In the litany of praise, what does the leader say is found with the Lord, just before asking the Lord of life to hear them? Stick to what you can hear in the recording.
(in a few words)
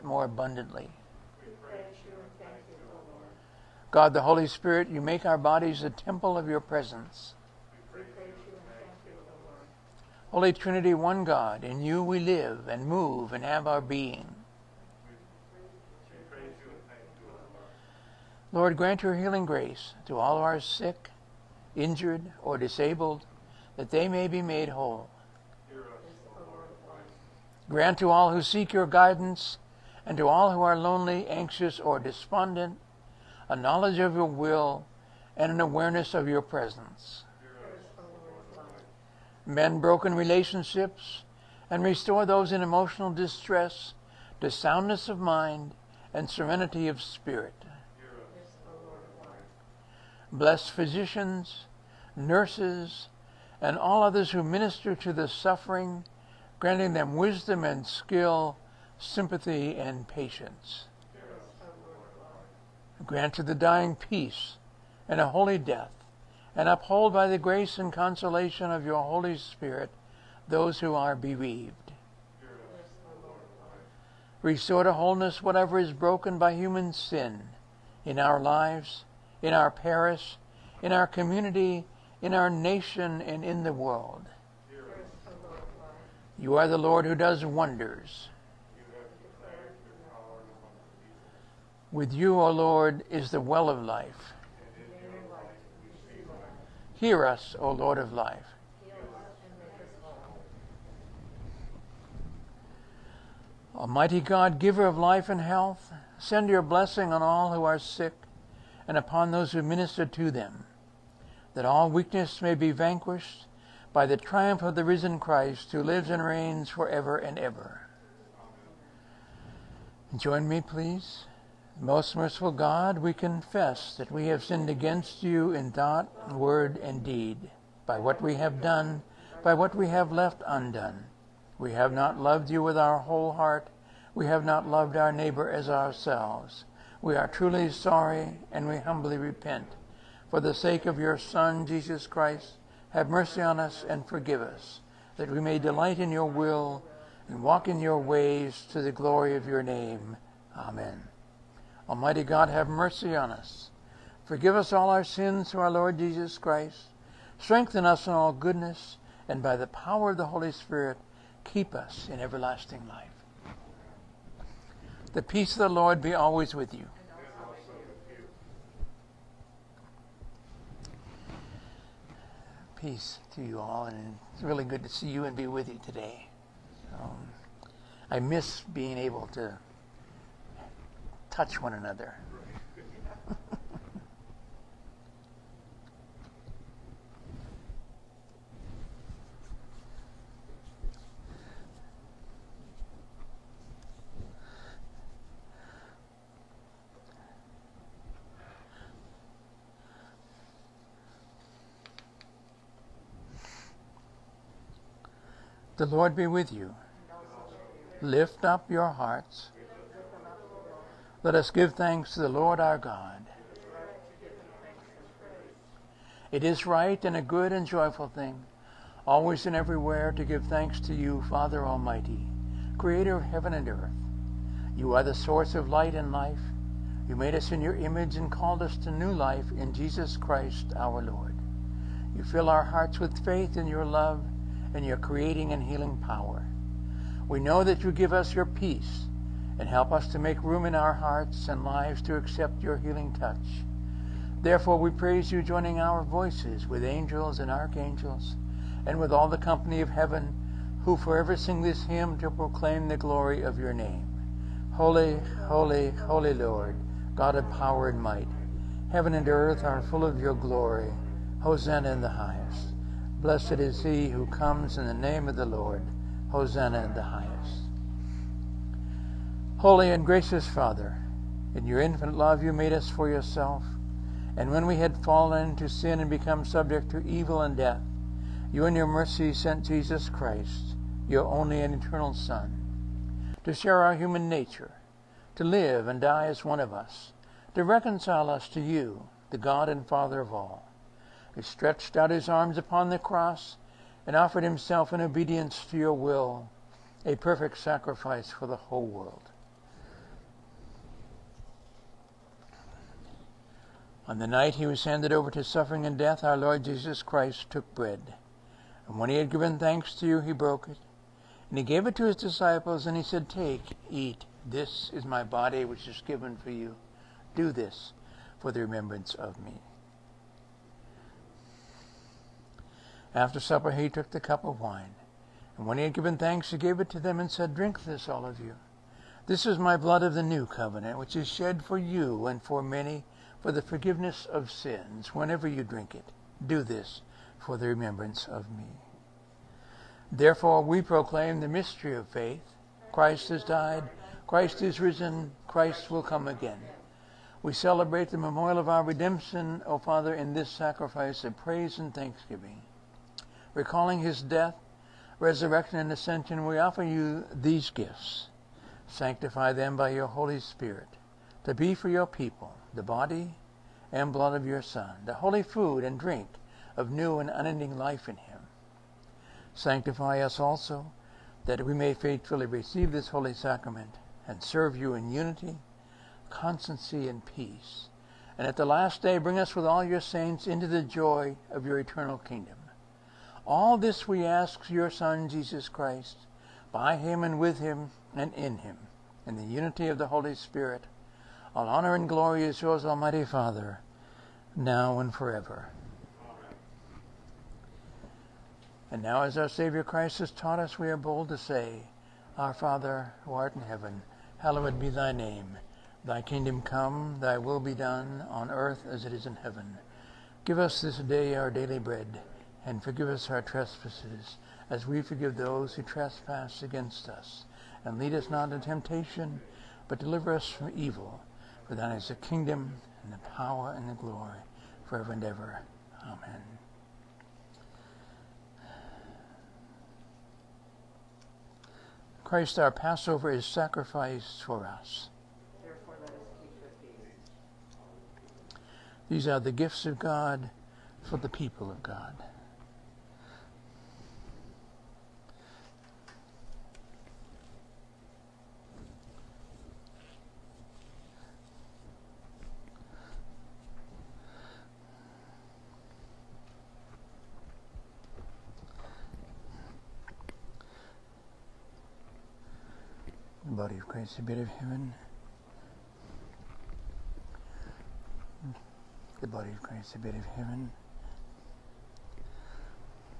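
the well of life.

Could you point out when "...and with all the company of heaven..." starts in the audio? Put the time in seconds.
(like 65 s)
248 s.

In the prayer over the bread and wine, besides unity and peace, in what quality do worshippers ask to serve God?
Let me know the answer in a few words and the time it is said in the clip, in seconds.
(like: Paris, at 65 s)
constancy, at 376 s.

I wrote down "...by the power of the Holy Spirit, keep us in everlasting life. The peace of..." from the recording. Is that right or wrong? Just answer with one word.
right.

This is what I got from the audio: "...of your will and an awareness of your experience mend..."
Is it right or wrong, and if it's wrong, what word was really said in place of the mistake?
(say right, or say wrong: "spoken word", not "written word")
wrong: "presence", not "experience".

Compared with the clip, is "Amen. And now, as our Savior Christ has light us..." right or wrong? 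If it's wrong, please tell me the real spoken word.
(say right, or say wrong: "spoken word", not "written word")
wrong: "taught", not "light".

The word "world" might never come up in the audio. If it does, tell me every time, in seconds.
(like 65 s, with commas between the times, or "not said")
83 s, 298 s.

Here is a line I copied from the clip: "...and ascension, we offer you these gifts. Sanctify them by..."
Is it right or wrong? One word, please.
right.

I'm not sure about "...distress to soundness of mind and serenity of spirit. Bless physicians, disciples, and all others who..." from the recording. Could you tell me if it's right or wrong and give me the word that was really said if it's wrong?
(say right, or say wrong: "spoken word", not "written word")
wrong: "nurses", not "disciples".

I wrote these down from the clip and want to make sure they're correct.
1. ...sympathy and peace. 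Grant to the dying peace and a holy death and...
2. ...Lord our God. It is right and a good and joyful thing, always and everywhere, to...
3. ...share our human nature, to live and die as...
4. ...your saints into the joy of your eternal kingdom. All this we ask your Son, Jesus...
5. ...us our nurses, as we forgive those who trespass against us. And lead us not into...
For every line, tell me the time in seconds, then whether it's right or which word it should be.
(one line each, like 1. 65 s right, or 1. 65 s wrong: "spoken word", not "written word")
1. 58 s wrong: "patience", not "peace"
2. 212 s right
3. 283 s right
4. 379 s right
5. 413 s wrong: "trespasses", not "nurses".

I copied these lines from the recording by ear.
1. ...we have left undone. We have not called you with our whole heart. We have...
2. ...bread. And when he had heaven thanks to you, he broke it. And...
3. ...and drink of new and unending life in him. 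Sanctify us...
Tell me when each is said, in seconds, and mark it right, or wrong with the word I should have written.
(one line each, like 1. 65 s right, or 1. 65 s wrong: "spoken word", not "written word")
1. 129 s wrong: "loved", not "called"
2. 307 s wrong: "given", not "heaven"
3. 365 s right.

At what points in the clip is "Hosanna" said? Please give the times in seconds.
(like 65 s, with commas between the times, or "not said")
261 s, 266 s.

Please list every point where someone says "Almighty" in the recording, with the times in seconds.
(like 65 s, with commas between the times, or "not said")
103 s, 151 s, 221 s, 392 s.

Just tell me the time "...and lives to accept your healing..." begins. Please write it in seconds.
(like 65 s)
241 s.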